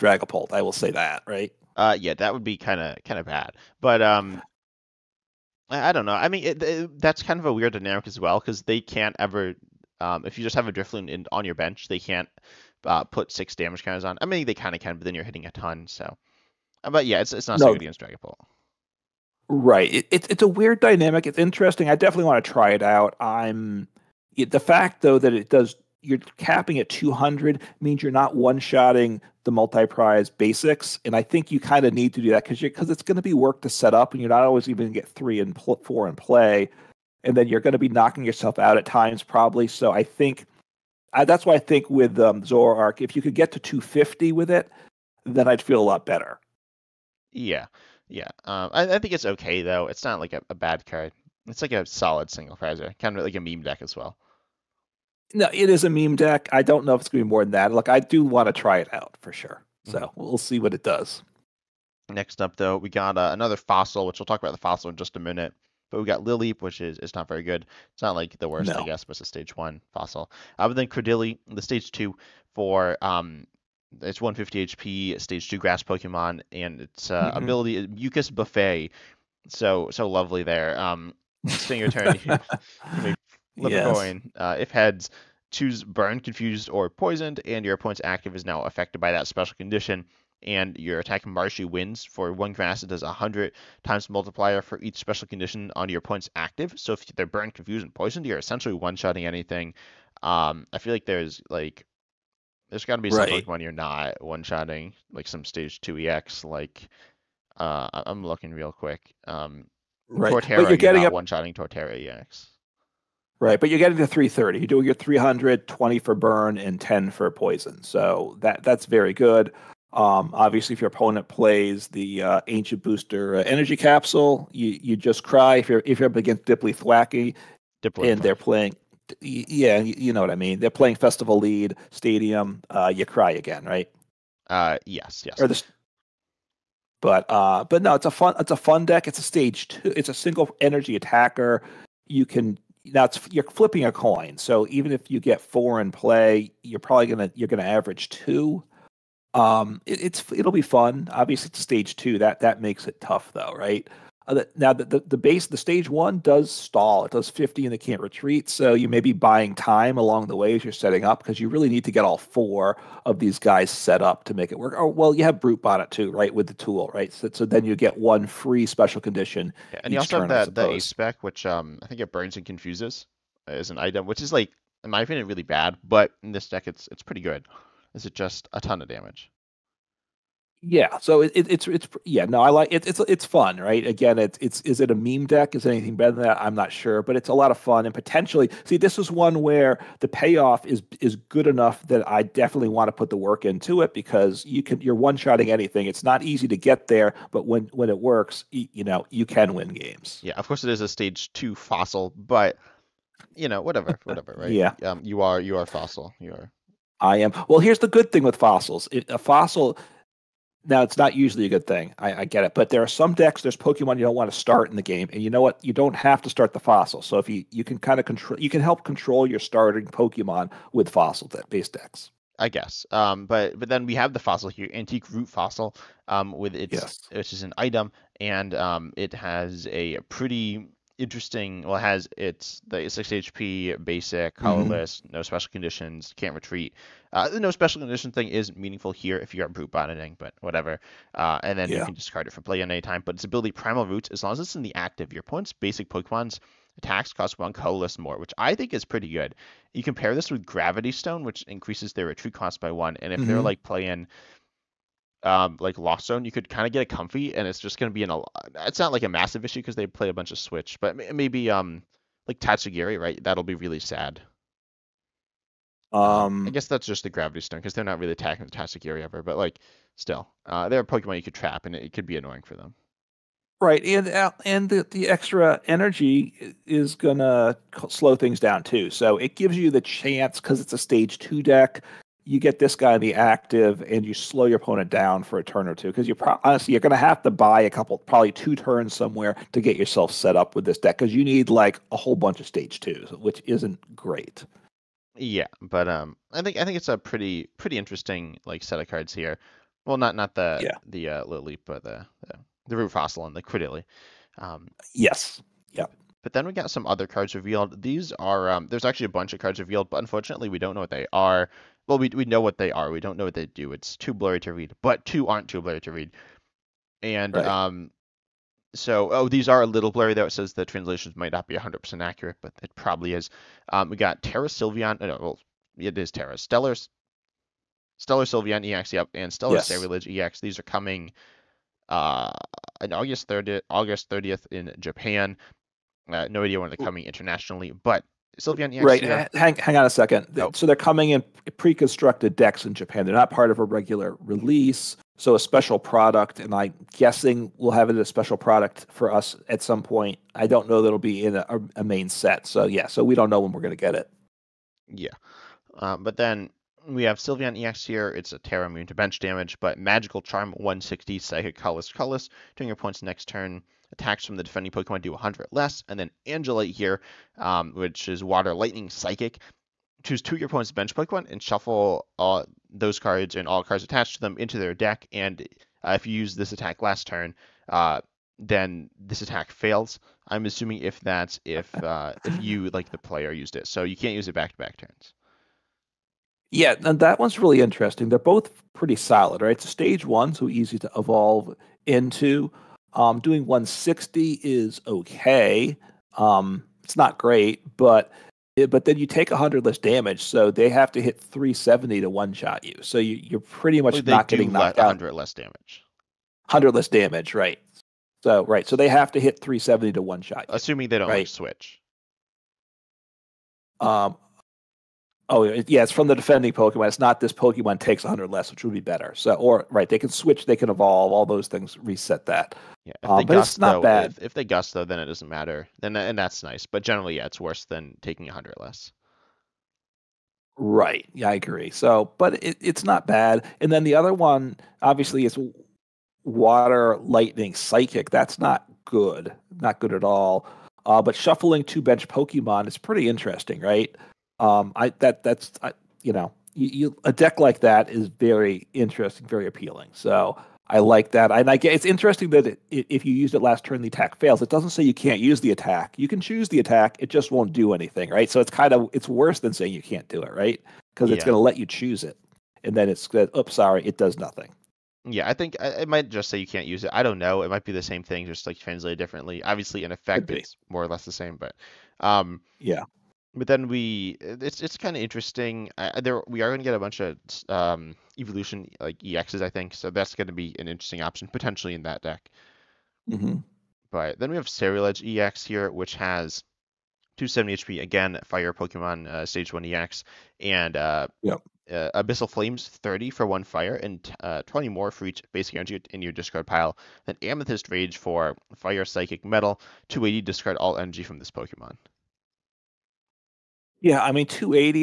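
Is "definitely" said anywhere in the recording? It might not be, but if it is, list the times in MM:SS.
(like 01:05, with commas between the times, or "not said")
00:21, 03:12.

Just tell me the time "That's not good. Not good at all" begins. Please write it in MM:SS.
07:18.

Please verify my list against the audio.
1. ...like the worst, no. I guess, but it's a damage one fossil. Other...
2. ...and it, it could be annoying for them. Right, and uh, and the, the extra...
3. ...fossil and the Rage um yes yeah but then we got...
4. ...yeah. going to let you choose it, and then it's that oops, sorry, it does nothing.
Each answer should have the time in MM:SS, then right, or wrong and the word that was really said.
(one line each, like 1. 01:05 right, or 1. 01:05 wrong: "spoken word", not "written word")
1. 01:08 wrong: "stage", not "damage"
2. 04:31 right
3. 05:02 wrong: "Cradily", not "Rage"
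4. 07:41 right.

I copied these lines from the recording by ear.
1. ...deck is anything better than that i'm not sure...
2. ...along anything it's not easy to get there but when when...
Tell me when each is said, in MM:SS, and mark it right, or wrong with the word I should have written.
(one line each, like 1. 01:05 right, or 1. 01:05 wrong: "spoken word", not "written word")
1. 03:05 right
2. 03:15 wrong: "shotting", not "along".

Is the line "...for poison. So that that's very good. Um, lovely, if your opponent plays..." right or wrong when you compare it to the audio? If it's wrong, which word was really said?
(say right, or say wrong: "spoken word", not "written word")
wrong: "obviously", not "lovely".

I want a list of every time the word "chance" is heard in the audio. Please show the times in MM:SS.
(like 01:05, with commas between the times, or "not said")
04:39.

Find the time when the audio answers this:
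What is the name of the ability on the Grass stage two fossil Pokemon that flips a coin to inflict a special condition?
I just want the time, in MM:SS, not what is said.
01:17.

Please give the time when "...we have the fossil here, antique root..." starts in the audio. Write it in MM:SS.
03:43.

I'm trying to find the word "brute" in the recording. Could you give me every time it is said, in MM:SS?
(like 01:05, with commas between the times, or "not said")
02:45, 03:59.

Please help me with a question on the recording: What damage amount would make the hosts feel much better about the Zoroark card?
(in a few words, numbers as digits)
250.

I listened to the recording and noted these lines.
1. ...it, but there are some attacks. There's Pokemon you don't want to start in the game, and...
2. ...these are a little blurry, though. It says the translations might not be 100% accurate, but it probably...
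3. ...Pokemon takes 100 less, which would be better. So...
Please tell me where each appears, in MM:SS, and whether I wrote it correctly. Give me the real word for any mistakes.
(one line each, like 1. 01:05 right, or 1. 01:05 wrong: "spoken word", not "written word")
1. 03:32 wrong: "decks", not "attacks"
2. 05:19 right
3. 06:57 right.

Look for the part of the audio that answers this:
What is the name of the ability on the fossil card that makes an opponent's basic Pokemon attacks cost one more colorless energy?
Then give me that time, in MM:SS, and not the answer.
04:03.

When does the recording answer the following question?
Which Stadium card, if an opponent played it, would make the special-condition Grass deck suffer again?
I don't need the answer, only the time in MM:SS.
02:10.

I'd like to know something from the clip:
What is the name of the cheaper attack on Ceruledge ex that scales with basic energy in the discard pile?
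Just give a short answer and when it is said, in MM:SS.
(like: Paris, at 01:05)
Abyssal Flames, at 08:11.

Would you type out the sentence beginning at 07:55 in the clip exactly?
Uh, there we are going to get a bunch of um, evolution like exes, I think.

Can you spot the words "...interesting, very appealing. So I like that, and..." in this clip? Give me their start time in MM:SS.
07:28.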